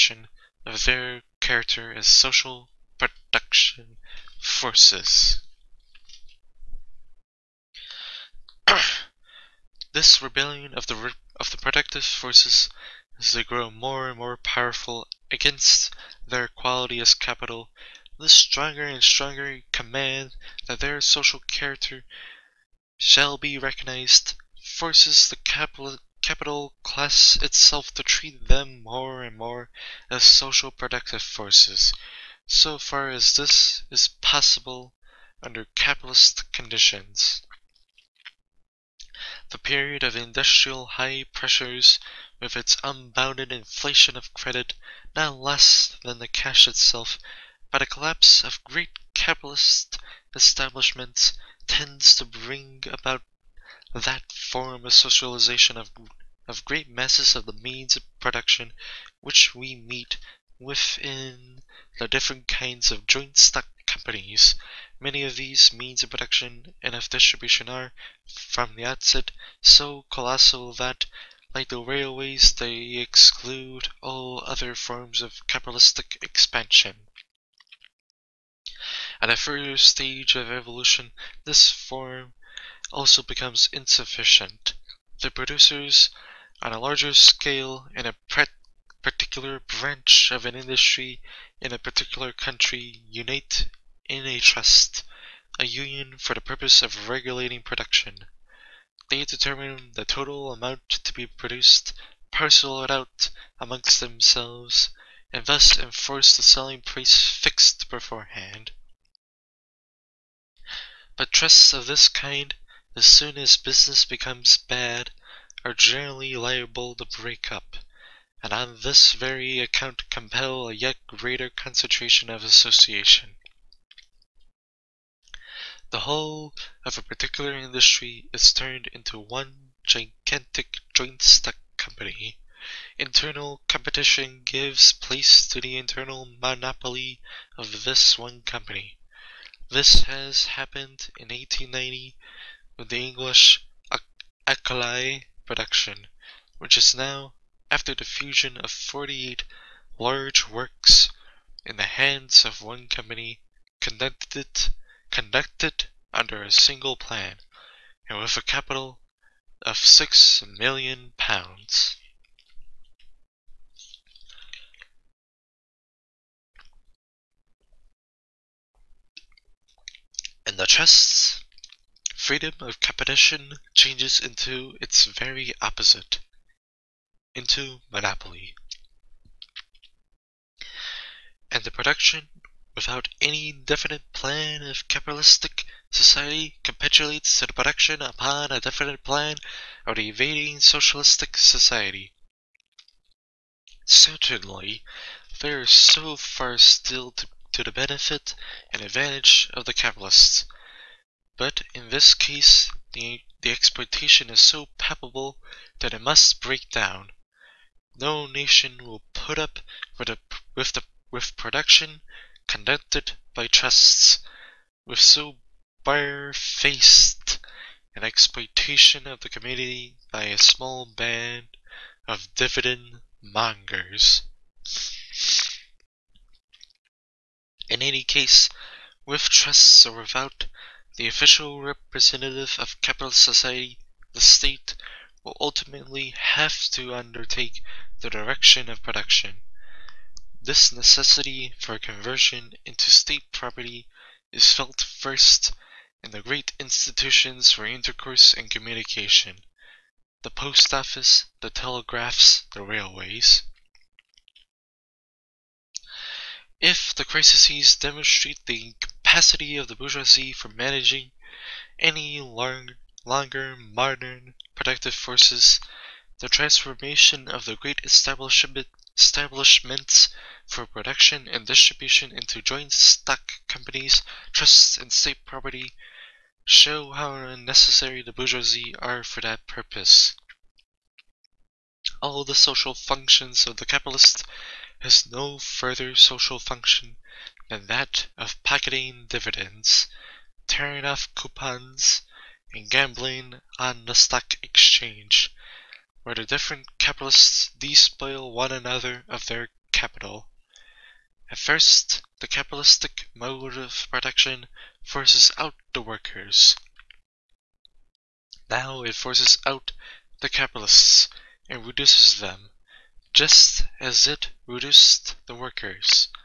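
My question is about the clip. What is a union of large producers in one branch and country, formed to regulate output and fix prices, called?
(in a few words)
trust.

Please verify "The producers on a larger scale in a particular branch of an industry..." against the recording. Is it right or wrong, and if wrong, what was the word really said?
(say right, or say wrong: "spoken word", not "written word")
right.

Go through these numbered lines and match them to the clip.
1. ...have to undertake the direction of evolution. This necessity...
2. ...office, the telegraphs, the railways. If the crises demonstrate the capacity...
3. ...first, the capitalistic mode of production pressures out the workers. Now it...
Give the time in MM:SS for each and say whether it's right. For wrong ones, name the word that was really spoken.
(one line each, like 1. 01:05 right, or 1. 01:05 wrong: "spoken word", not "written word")
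1. 03:56 wrong: "production", not "evolution"
2. 04:10 right
3. 05:01 wrong: "forces", not "pressures".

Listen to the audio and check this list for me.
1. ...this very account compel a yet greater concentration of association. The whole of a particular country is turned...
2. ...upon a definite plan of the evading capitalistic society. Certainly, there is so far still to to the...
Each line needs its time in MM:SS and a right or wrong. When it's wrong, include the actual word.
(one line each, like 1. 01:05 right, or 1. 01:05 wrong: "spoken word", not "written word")
1. 01:58 wrong: "industry", not "country"
2. 03:07 wrong: "socialistic", not "capitalistic".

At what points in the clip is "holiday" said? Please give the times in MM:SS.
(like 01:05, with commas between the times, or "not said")
not said.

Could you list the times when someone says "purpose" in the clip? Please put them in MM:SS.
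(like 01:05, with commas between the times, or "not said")
01:36, 04:39.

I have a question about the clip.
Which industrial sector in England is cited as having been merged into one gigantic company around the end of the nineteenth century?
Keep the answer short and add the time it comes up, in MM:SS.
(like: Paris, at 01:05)
alkali production, at 02:24.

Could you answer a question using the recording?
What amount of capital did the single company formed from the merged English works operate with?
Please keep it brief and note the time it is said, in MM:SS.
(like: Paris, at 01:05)
6 million pounds, at 02:39.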